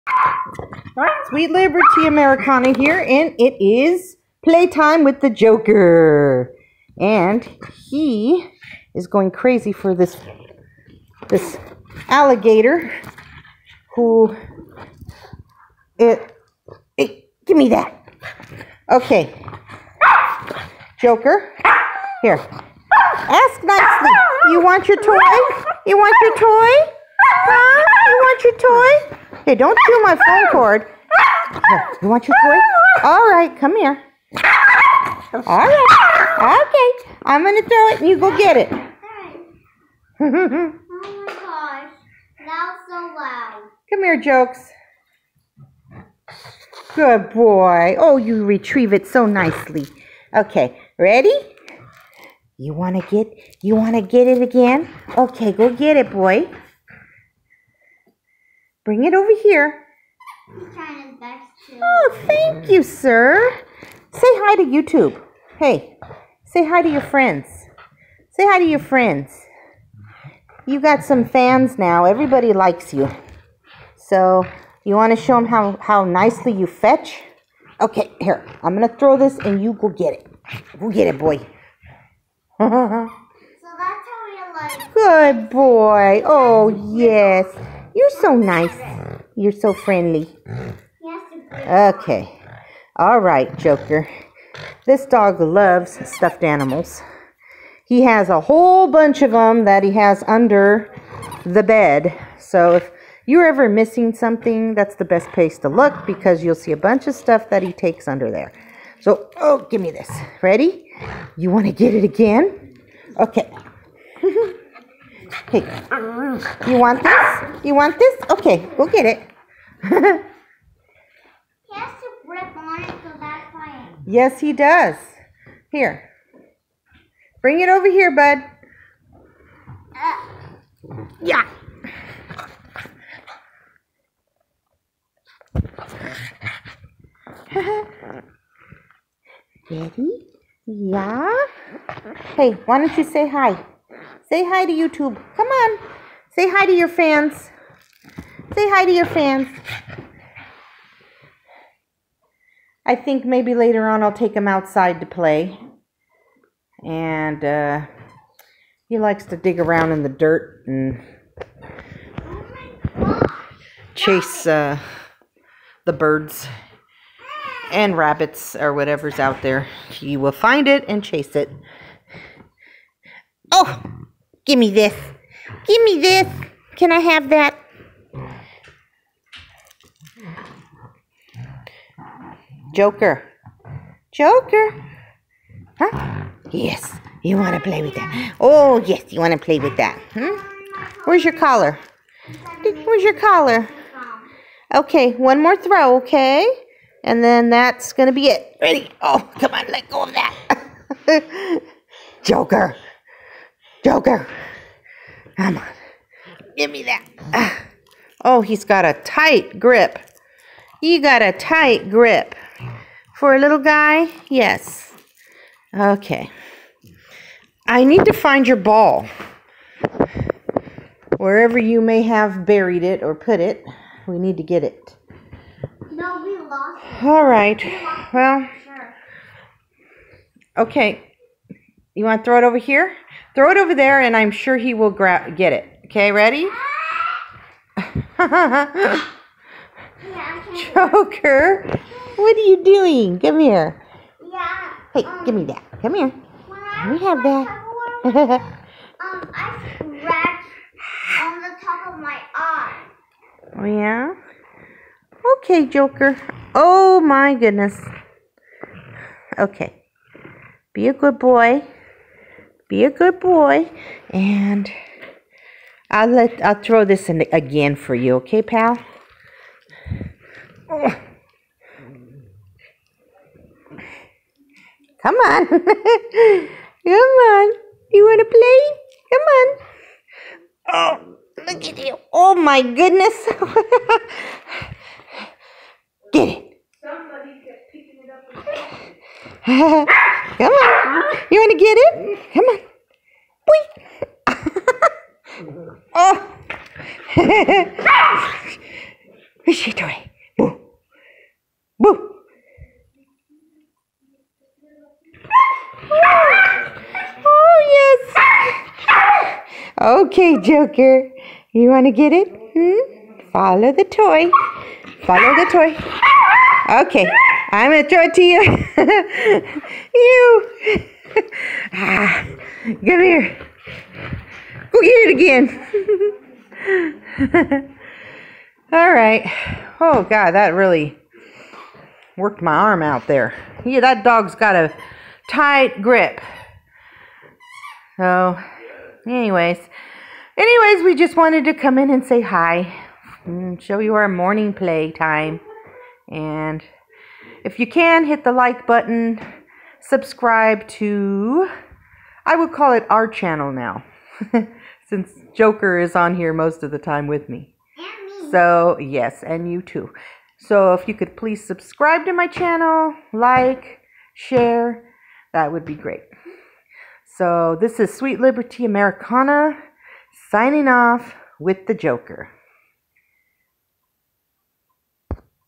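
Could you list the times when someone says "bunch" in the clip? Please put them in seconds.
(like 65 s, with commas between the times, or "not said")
98 s, 106 s.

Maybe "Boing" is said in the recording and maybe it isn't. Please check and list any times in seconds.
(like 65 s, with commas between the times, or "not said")
295 s.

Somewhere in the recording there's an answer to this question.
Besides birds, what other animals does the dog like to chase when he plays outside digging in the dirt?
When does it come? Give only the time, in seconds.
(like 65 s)
167 s.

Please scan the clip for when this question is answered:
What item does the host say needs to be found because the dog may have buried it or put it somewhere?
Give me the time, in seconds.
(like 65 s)
218 s.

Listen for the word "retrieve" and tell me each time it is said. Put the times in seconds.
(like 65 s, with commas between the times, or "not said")
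48 s.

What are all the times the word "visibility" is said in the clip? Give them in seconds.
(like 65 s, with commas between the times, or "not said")
not said.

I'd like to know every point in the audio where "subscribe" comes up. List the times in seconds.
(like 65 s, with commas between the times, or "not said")
349 s, 361 s.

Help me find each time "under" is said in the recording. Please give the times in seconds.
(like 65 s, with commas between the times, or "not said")
100 s, 108 s.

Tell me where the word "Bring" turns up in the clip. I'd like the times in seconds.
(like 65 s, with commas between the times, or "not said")
58 s, 127 s.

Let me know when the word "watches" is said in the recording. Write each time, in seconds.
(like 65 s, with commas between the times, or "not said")
not said.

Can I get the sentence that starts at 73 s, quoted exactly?
So you want to show them how, how nicely you fetch?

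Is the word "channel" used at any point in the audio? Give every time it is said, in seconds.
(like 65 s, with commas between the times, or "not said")
353 s, 362 s.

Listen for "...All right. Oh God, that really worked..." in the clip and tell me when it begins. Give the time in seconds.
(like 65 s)
328 s.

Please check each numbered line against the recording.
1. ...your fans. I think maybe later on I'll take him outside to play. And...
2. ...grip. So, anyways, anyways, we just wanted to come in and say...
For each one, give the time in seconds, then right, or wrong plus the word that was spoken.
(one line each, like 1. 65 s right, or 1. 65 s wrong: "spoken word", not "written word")
1. 148 s right
2. 335 s right.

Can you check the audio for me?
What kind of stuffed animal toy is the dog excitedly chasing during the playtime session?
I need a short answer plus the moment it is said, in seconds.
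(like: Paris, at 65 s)
alligator, at 12 s.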